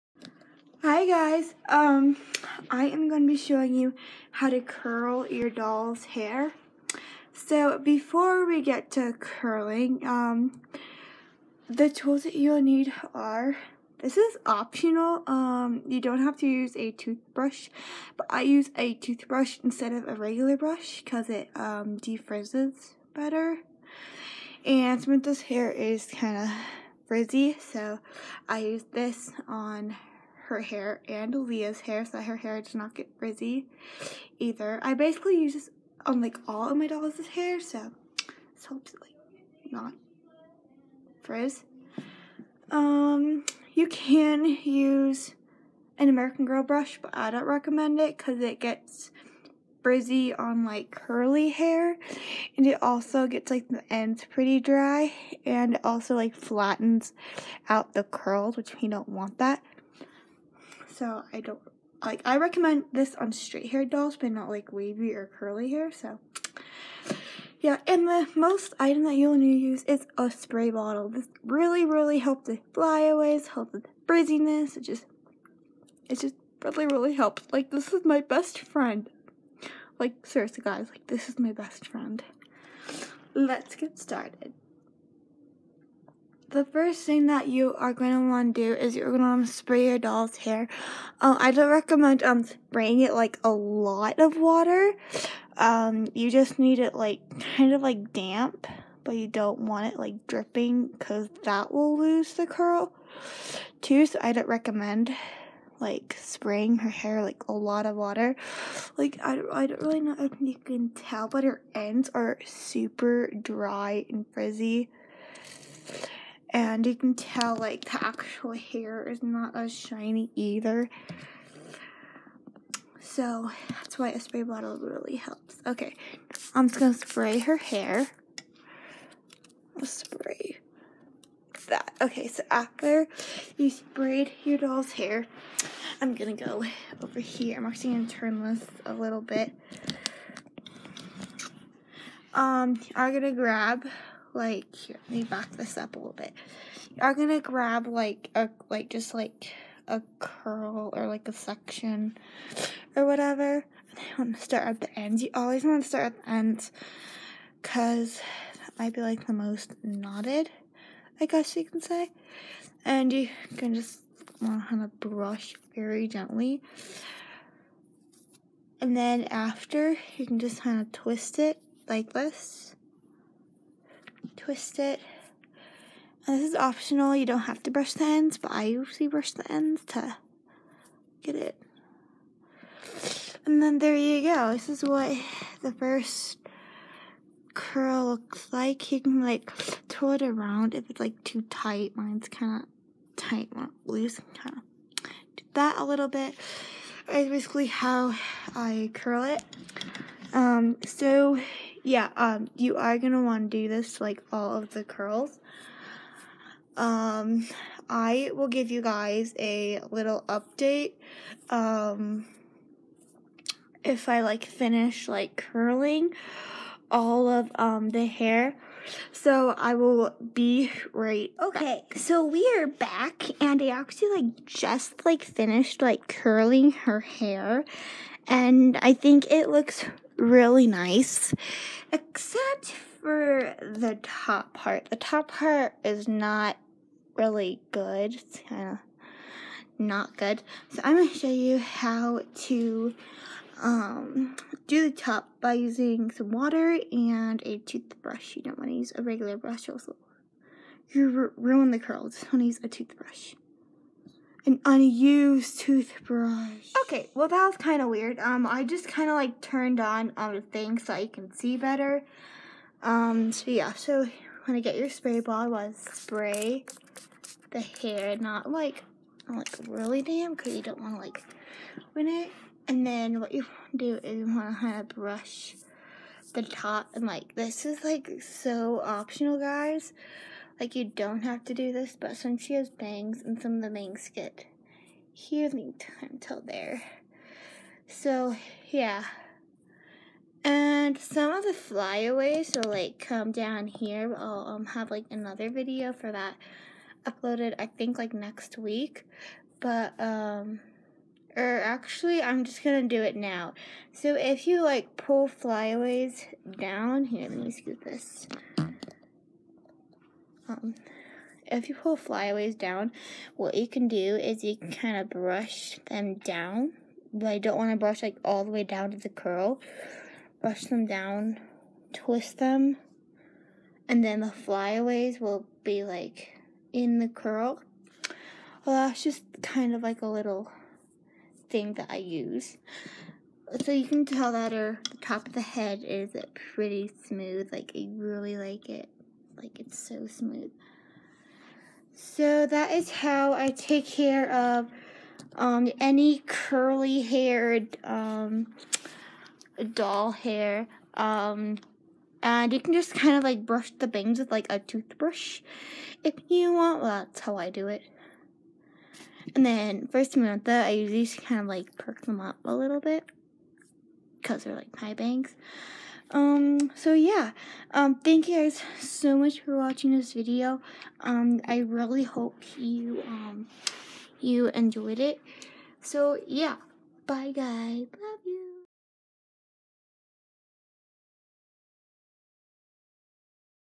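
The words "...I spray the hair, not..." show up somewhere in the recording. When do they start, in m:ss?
4:25.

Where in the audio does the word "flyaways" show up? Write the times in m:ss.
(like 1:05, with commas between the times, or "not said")
1:12, 4:51, 5:05, 5:11, 5:24.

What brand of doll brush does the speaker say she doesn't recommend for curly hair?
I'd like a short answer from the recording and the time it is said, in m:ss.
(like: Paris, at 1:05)
American Girl, at 0:46.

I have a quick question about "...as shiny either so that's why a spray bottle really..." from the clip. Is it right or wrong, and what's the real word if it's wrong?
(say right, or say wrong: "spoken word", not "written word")
right.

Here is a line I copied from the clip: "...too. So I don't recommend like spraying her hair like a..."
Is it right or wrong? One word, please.
right.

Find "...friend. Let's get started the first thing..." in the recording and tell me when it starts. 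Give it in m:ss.
1:21.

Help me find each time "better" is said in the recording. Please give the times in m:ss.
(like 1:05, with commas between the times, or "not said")
0:23, 4:21.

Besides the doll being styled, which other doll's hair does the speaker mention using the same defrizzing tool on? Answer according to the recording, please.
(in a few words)
Leah.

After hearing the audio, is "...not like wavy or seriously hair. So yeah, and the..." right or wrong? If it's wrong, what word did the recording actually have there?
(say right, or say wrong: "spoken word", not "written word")
wrong: "curly", not "seriously".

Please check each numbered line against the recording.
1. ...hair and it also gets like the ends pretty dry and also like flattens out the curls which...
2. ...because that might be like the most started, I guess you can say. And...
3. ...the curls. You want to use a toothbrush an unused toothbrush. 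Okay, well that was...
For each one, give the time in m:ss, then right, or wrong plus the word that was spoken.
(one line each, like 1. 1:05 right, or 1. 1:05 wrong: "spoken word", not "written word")
1. 0:51 right
2. 2:37 wrong: "knotted", not "started"
3. 4:11 right.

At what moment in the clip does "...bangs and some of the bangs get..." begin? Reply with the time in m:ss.
4:42.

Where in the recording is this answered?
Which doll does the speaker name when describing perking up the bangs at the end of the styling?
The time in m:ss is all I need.
6:00.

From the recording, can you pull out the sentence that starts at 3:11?
Mine's kind of tight, not loose.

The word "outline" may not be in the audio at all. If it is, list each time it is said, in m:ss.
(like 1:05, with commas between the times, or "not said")
not said.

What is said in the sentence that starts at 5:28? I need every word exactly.
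Well, that's just kind of like a little thing that I use.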